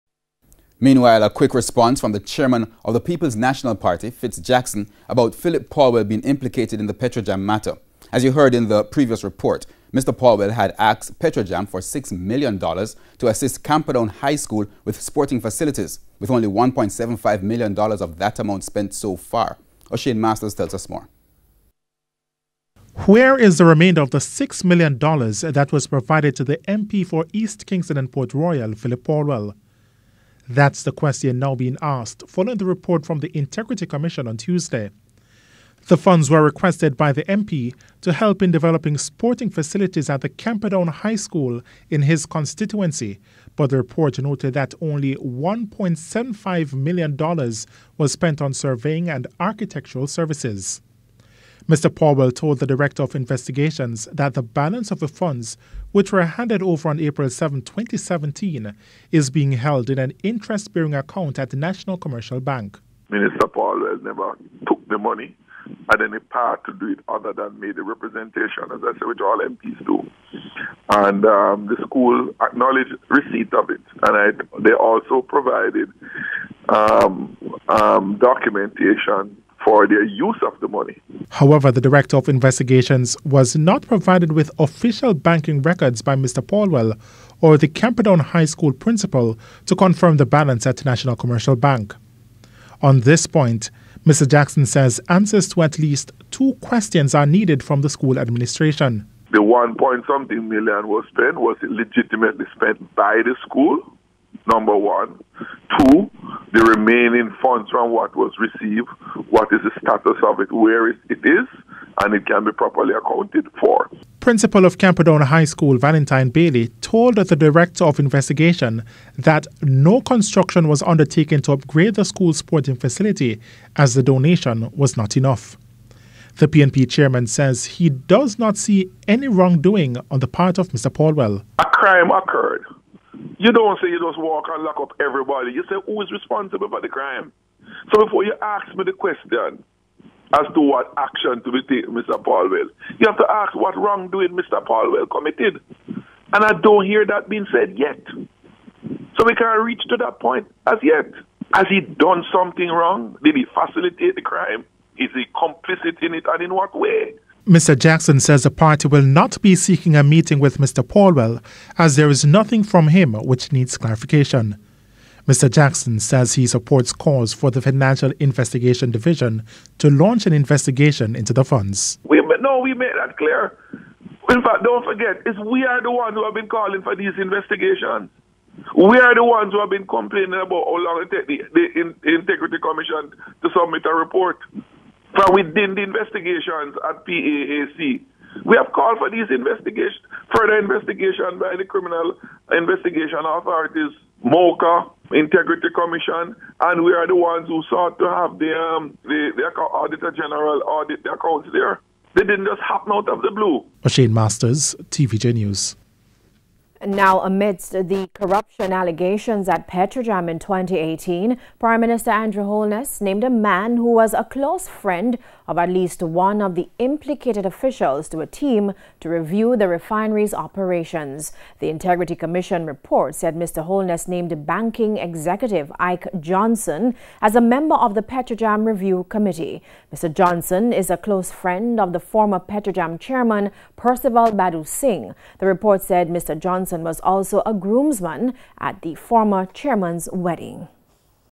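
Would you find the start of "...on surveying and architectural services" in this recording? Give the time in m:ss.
0:48.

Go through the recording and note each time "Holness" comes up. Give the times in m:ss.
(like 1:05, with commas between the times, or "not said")
3:32, 3:43.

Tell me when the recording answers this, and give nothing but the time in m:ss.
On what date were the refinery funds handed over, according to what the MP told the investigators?
0:56.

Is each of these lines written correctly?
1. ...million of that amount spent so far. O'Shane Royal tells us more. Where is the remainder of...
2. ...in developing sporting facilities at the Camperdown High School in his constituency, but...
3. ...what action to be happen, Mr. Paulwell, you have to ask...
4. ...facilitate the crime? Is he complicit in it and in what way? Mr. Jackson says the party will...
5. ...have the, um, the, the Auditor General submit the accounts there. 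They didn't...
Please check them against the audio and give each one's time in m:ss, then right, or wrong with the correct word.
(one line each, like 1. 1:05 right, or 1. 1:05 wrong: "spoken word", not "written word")
1. 0:17 wrong: "Masters", not "Royal"
2. 0:38 right
3. 2:20 wrong: "taken", not "happen"
4. 2:33 right
5. 3:18 wrong: "audit", not "submit".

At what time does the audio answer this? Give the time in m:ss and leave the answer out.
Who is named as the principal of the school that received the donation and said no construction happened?
1:55.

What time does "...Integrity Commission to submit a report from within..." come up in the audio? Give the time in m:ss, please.
3:02.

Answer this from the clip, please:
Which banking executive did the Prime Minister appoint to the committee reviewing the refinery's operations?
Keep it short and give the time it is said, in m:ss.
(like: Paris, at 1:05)
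Ike Johnson, at 3:45.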